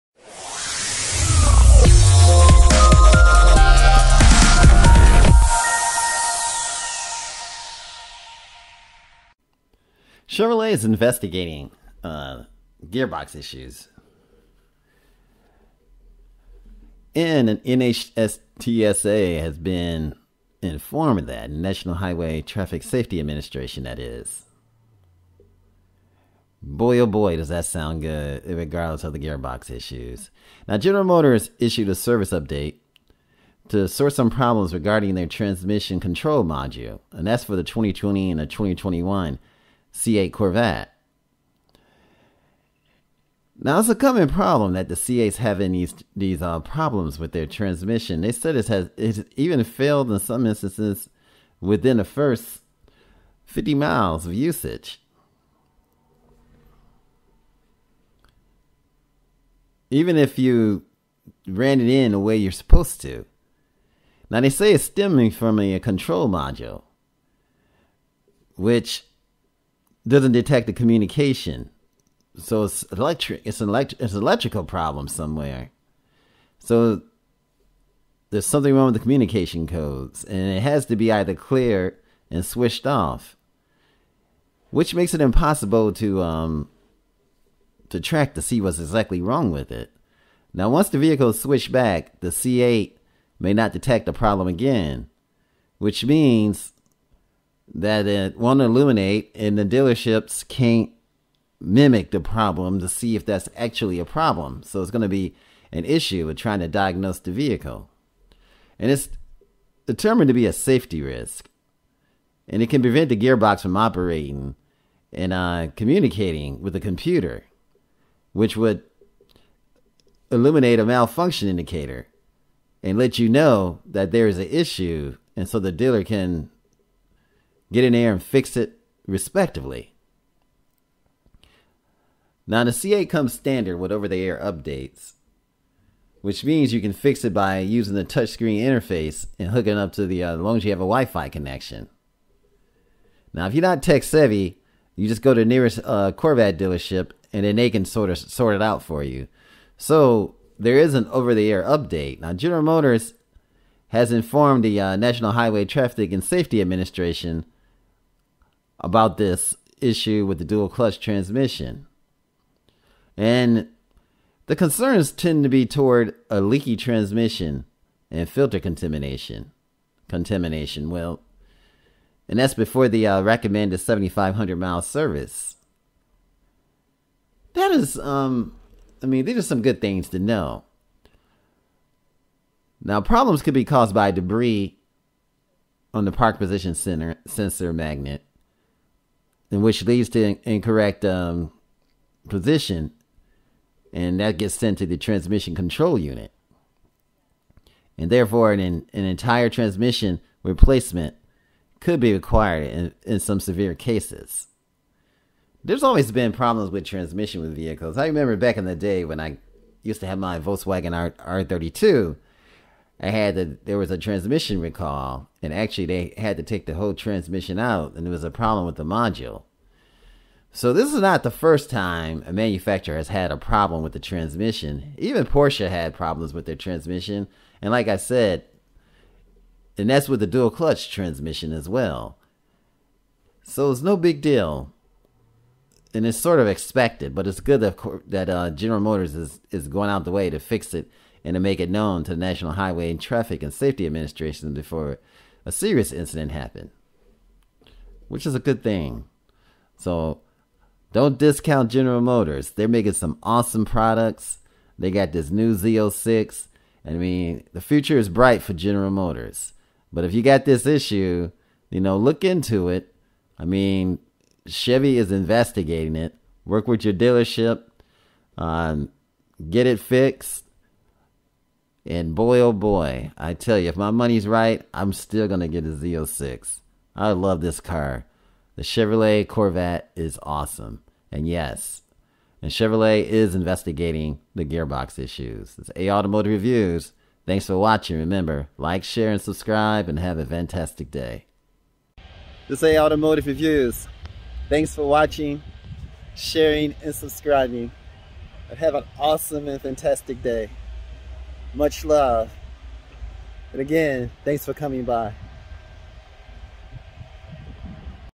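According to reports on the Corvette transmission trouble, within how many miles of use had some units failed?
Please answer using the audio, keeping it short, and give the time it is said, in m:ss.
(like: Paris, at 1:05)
50 miles, at 0:53.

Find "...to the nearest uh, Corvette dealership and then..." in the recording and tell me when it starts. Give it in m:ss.
2:25.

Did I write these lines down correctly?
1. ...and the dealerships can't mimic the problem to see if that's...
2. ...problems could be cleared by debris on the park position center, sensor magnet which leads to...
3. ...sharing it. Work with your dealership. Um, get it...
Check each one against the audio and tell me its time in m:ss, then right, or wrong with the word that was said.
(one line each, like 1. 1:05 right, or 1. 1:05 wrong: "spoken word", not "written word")
1. 1:39 right
2. 3:03 wrong: "caused", not "cleared"
3. 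4:25 wrong: "investigating", not "sharing".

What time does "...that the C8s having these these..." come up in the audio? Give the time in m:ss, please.
0:44.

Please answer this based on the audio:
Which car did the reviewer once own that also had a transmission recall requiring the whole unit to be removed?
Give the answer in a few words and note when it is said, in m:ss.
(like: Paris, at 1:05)
Volkswagen R32, at 3:30.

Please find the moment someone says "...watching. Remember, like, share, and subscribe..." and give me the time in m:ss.
4:47.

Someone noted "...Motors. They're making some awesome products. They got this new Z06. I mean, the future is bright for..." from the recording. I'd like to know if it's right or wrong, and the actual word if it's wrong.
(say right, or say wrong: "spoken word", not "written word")
right.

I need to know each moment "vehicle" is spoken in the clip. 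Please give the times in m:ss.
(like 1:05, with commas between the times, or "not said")
1:30, 1:47, 3:27.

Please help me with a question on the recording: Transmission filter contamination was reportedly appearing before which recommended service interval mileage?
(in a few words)
7,500 miles.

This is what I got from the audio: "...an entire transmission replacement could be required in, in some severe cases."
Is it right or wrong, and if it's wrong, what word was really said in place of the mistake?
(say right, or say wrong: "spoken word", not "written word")
right.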